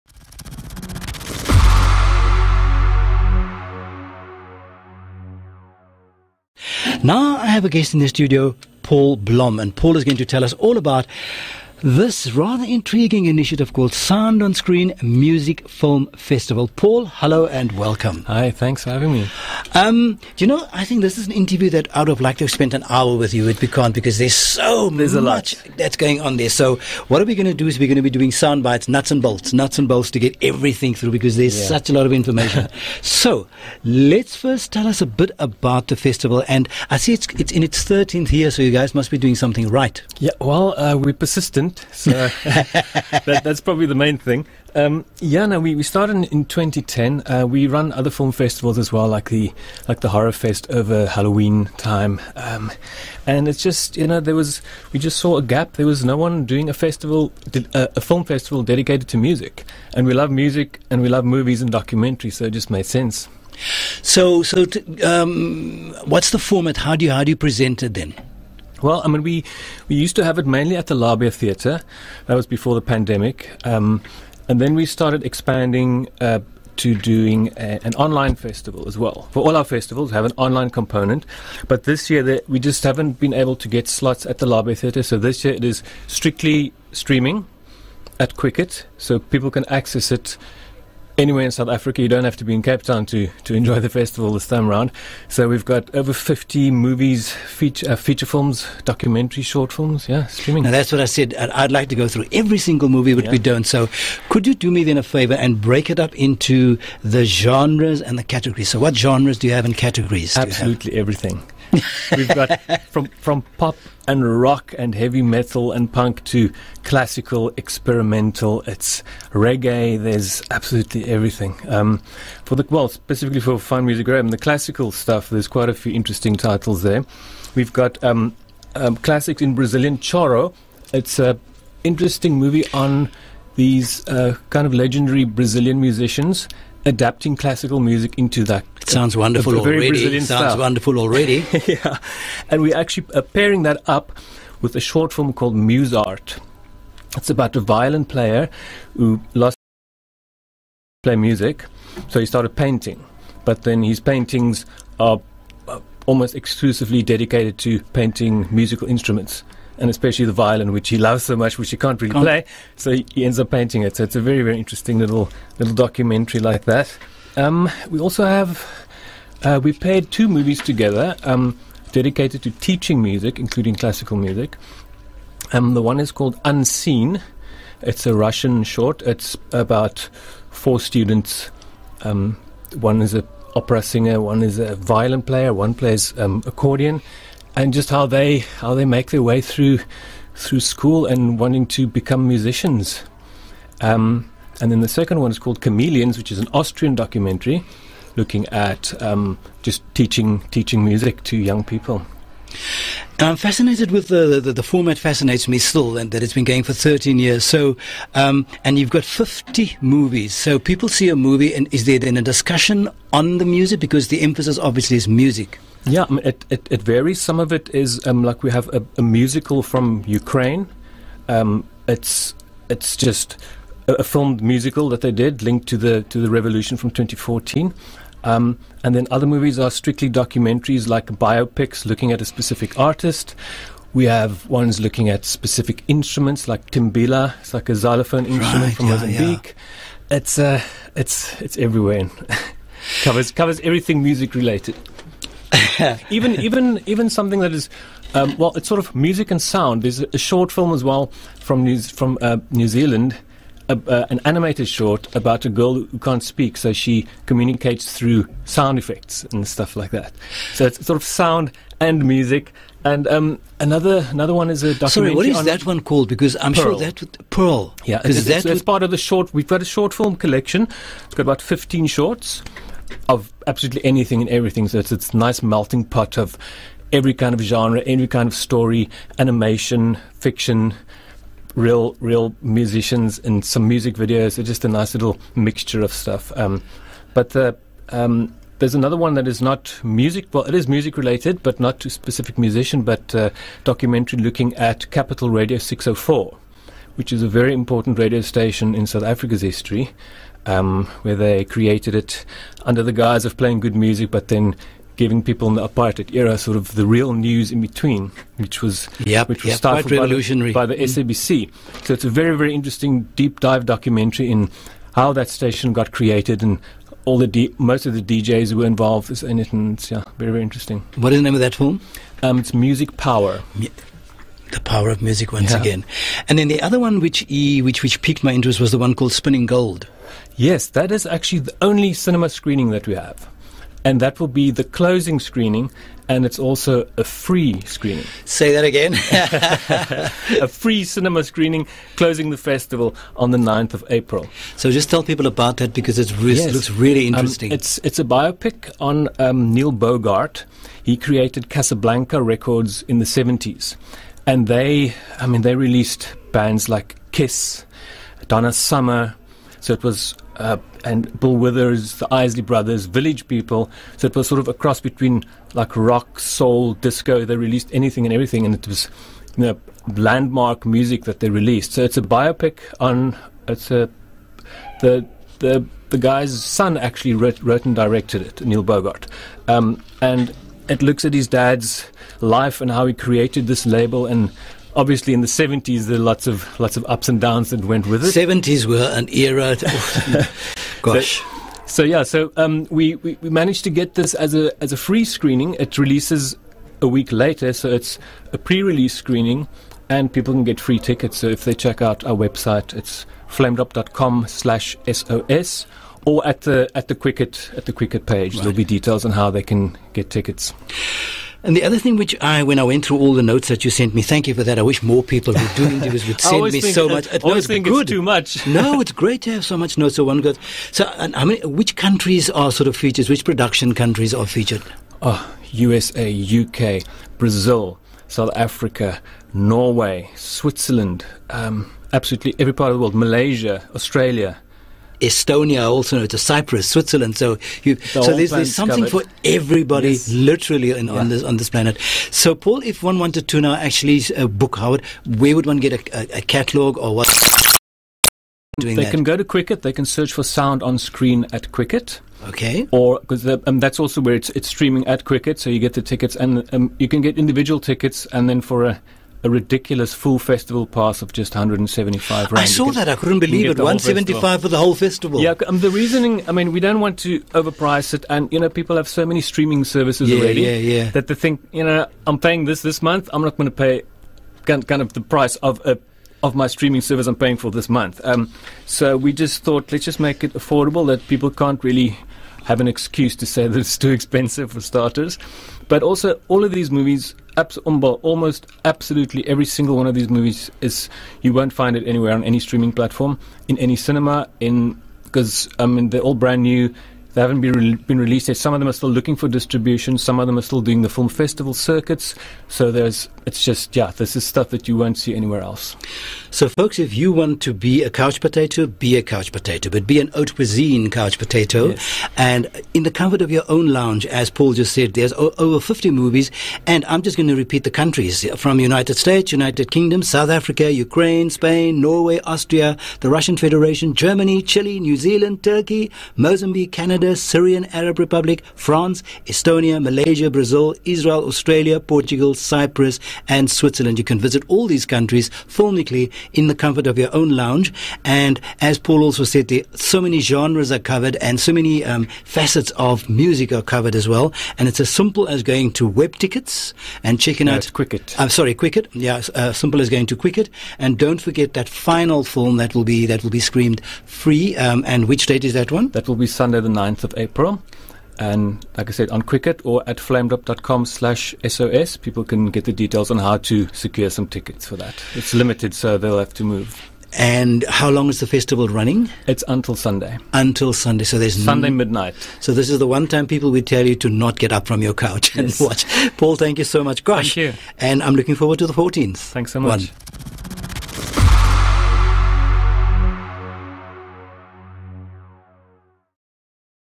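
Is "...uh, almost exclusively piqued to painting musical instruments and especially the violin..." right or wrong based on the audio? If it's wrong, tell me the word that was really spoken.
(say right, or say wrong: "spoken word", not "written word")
wrong: "dedicated", not "piqued".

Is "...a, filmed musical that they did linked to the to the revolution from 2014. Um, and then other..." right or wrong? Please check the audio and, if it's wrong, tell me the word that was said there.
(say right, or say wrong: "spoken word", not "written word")
right.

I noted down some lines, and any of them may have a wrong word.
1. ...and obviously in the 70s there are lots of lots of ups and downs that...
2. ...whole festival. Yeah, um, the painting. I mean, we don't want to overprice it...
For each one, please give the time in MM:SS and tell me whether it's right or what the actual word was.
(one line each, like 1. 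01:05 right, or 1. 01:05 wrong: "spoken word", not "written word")
1. 06:24 right
2. 07:44 wrong: "reasoning", not "painting".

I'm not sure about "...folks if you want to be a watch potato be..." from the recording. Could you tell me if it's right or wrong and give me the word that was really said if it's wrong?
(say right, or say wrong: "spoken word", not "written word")
wrong: "couch", not "watch".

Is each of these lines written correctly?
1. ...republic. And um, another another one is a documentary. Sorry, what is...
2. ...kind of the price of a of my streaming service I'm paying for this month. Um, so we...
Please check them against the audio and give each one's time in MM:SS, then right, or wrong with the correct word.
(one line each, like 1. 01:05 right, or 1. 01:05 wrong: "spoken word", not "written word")
1. 04:22 wrong: "music", not "republic"
2. 07:54 right.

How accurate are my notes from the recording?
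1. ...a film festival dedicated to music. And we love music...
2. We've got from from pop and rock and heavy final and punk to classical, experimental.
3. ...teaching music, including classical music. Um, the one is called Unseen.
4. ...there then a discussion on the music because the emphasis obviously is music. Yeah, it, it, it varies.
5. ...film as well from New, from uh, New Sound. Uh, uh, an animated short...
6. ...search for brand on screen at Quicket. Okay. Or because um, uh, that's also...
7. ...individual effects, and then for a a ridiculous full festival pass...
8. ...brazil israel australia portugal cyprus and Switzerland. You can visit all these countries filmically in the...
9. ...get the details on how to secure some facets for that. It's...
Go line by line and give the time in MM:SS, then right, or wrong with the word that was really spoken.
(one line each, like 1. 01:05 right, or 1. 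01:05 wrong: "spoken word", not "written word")
1. 00:57 right
2. 01:52 wrong: "metal", not "final"
3. 02:52 right
4. 03:31 right
5. 04:10 wrong: "Zealand", not "Sound"
6. 07:29 wrong: "sound", not "brand"
7. 07:37 wrong: "tickets", not "effects"
8. 08:50 right
9. 09:22 wrong: "tickets", not "facets".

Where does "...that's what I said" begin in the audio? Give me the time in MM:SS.
01:40.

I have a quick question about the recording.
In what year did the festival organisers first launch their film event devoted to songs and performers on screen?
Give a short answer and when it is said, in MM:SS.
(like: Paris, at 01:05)
2010, at 00:46.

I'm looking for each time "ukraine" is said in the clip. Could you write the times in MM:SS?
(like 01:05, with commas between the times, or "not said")
03:40, 08:40.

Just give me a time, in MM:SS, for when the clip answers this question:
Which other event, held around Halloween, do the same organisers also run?
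00:50.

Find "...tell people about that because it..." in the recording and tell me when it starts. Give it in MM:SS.
05:44.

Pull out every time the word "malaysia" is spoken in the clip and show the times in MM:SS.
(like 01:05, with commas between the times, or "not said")
07:12, 08:49.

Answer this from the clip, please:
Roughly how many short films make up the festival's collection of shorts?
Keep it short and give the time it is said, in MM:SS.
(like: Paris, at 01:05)
15, at 04:31.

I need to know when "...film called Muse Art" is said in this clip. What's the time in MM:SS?
02:25.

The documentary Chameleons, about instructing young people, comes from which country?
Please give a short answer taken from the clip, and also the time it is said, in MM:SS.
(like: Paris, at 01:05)
Austria, at 03:16.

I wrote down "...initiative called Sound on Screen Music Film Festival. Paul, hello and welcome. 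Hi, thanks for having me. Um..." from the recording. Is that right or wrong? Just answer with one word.
right.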